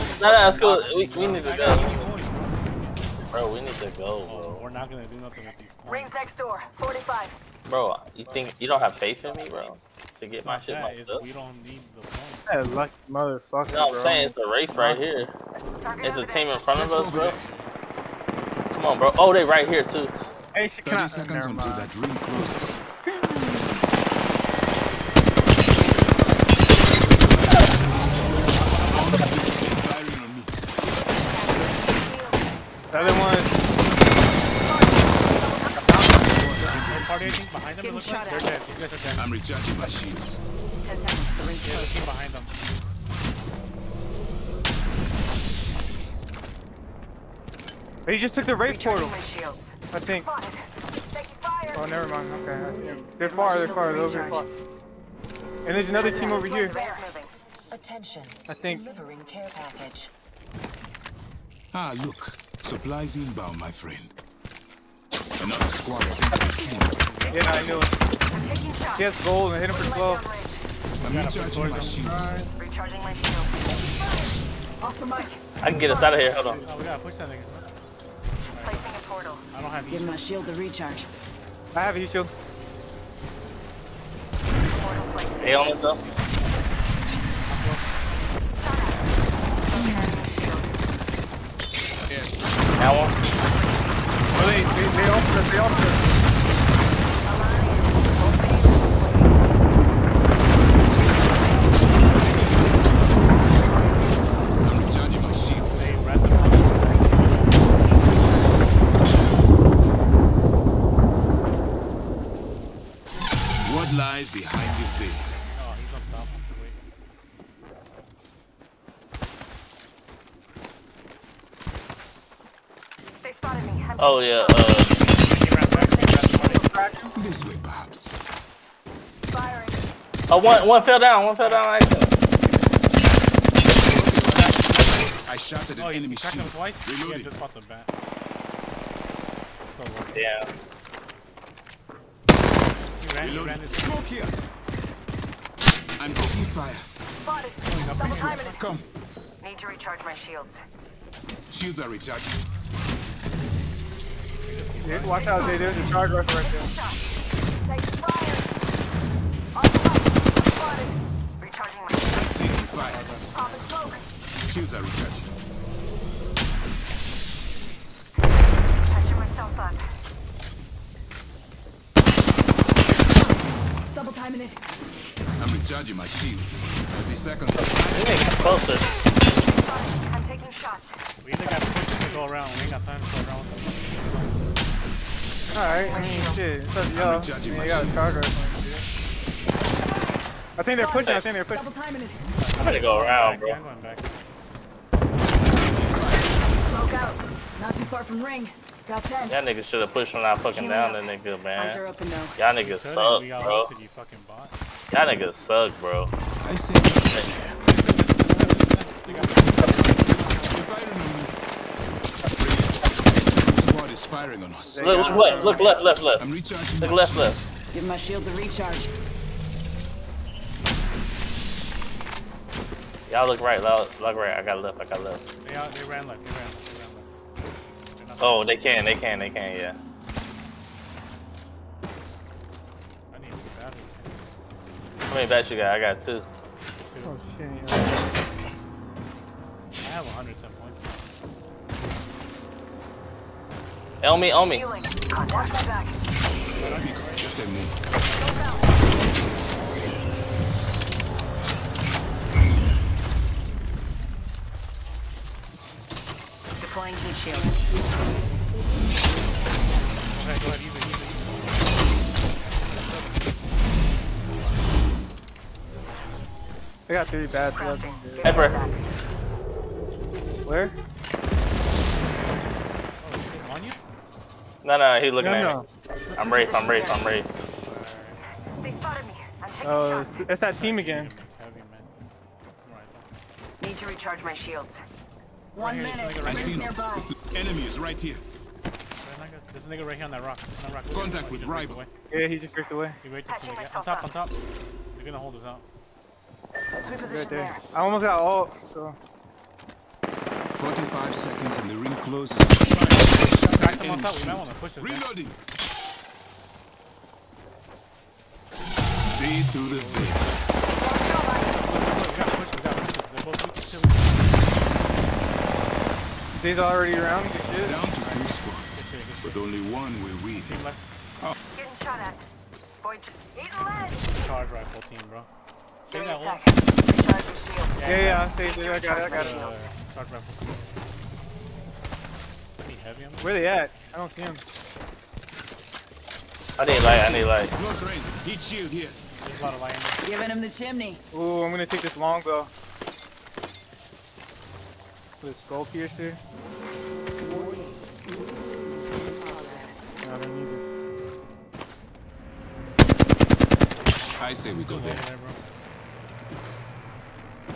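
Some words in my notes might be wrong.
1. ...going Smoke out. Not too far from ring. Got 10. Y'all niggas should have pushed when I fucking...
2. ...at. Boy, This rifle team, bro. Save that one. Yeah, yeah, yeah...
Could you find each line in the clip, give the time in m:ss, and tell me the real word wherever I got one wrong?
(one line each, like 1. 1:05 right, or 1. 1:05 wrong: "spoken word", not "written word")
1. 3:13 right
2. 5:21 wrong: "Charge", not "This".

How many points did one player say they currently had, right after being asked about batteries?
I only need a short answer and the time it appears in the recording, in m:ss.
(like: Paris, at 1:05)
110, at 4:00.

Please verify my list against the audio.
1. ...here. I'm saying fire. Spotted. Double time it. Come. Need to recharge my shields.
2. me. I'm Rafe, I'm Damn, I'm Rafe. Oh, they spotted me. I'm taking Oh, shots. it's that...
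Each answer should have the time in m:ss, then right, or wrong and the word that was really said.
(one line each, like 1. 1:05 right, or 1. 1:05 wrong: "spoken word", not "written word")
1. 2:24 wrong: "taking", not "saying"
2. 4:36 wrong: "Rafe", not "Damn".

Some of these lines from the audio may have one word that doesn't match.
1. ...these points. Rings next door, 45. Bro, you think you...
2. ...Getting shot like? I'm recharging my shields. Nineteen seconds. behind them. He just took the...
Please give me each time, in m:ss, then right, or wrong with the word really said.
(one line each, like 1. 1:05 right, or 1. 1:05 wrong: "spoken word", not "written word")
1. 0:05 right
2. 0:37 wrong: "Ten", not "Nineteen".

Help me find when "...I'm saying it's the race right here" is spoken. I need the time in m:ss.
0:13.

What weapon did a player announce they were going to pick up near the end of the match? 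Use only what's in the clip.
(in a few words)
Longbow.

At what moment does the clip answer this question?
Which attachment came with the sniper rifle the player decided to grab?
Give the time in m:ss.
5:45.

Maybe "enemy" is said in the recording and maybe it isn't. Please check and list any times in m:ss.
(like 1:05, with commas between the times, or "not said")
2:15, 4:47.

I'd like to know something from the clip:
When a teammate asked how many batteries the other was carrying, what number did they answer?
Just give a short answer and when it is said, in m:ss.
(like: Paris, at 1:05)
2, at 3:55.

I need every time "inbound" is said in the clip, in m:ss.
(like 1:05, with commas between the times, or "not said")
1:03.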